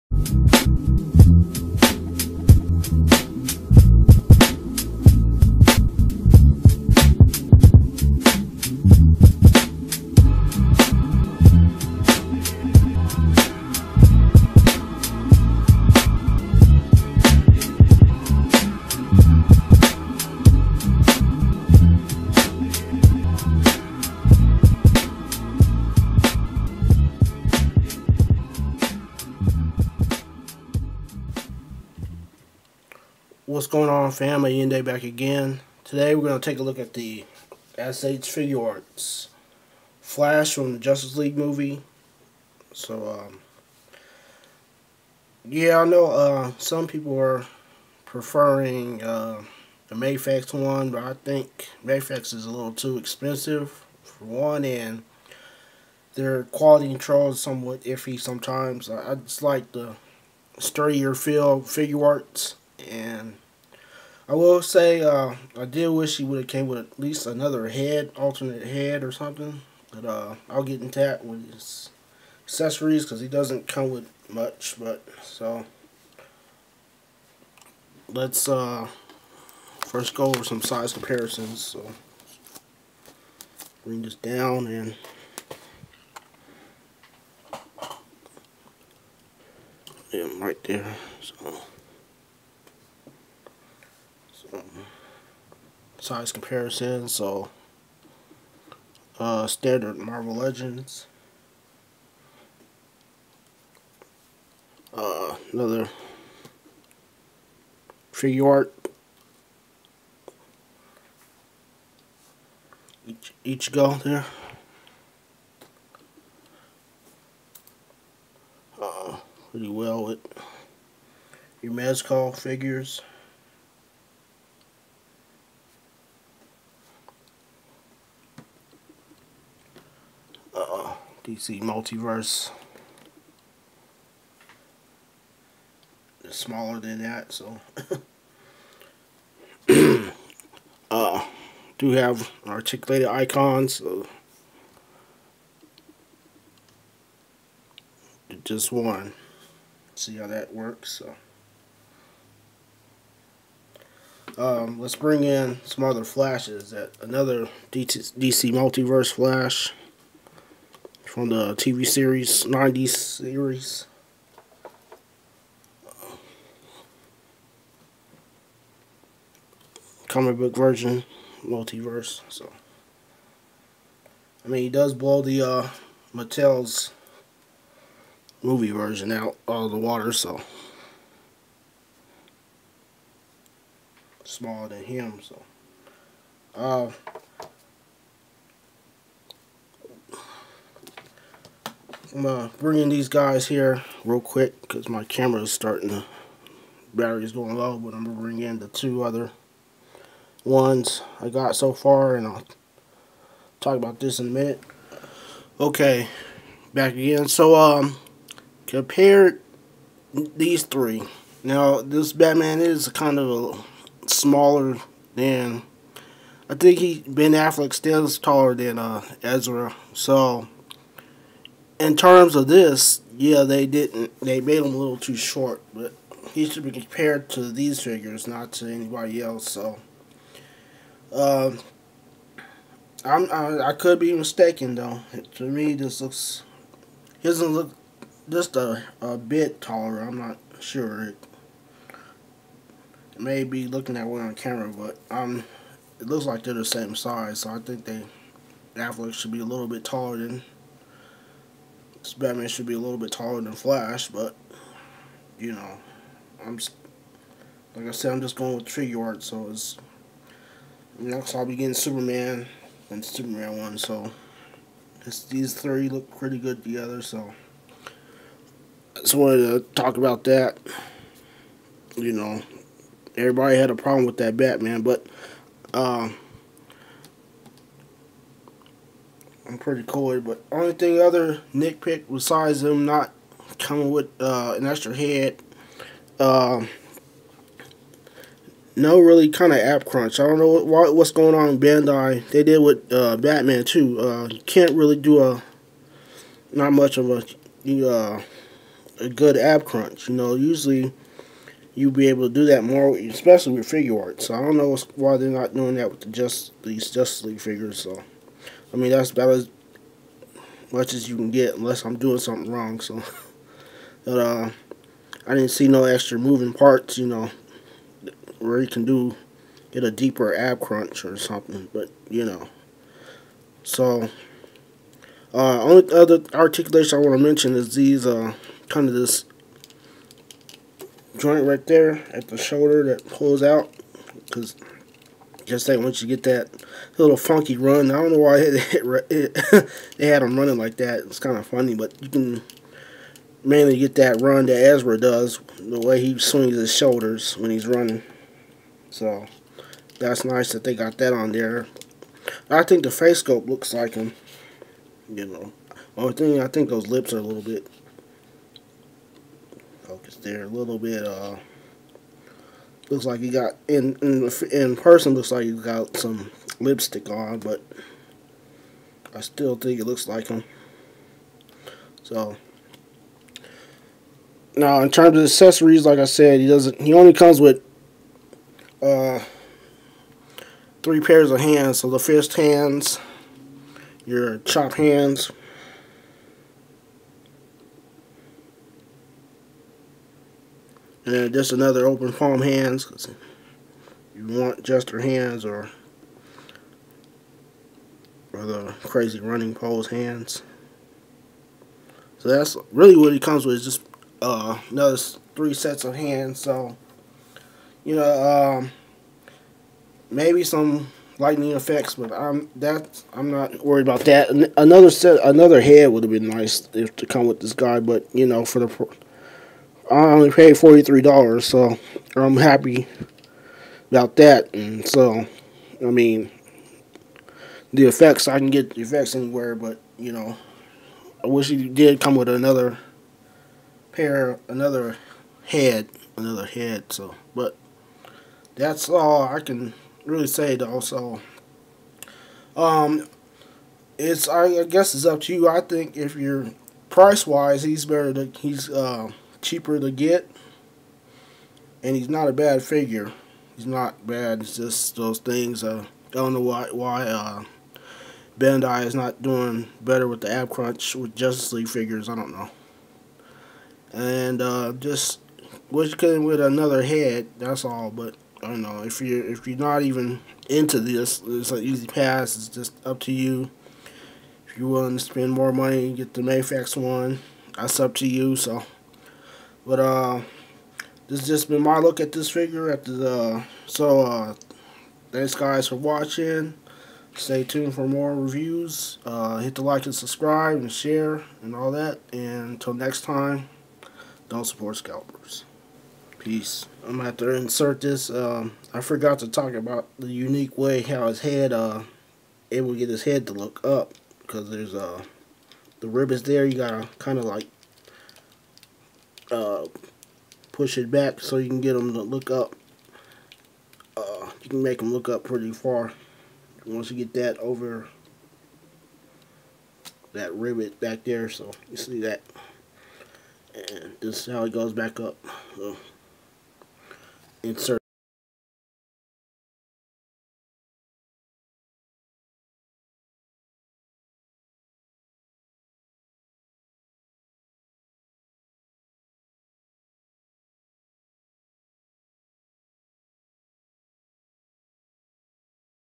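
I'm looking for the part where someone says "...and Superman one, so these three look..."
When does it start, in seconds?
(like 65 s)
262 s.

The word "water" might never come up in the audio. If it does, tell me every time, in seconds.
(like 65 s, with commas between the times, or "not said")
179 s.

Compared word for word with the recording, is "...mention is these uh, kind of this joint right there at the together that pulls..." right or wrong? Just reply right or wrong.
wrong.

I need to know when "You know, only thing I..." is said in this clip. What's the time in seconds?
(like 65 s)
355 s.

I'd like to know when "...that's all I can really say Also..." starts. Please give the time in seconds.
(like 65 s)
438 s.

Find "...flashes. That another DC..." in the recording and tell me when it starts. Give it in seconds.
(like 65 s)
156 s.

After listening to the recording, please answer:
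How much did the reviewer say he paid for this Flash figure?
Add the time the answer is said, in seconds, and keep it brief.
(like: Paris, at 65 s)
$43, at 420 s.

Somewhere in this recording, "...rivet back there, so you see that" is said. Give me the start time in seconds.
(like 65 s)
520 s.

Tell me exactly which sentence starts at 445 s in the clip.
I think if you're price wise, he's better.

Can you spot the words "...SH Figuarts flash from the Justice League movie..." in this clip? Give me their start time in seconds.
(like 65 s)
37 s.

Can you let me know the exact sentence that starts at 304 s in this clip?
So I don't know why they're not doing that with the just these Justice League figures.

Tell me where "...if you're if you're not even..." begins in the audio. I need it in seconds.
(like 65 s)
468 s.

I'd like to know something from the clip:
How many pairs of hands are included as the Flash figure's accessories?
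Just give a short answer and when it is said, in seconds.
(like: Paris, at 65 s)
3, at 380 s.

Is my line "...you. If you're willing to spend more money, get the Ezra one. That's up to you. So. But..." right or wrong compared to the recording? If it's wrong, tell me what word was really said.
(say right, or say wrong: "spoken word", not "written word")
wrong: "Mafex", not "Ezra".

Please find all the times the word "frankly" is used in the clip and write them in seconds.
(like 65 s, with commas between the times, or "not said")
not said.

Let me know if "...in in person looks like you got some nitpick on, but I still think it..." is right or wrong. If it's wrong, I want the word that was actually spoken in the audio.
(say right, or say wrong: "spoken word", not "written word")
wrong: "lipstick", not "nitpick".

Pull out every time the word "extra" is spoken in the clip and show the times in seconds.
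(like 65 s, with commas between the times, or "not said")
284 s, 315 s.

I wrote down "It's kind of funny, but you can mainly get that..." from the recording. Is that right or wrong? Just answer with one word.
right.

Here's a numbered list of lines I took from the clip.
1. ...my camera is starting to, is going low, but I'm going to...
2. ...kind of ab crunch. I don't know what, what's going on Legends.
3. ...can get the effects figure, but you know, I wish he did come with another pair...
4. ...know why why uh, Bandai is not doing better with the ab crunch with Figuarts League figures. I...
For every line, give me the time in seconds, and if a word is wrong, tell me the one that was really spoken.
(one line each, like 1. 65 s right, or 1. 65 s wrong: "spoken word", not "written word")
1. 194 s right
2. 289 s wrong: "Bandai", not "Legends"
3. 428 s wrong: "anywhere", not "figure"
4. 456 s wrong: "Justice", not "Figuarts".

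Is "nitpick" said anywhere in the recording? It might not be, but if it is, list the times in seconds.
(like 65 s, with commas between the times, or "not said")
281 s.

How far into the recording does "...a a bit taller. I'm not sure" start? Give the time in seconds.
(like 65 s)
238 s.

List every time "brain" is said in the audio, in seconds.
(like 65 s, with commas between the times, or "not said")
not said.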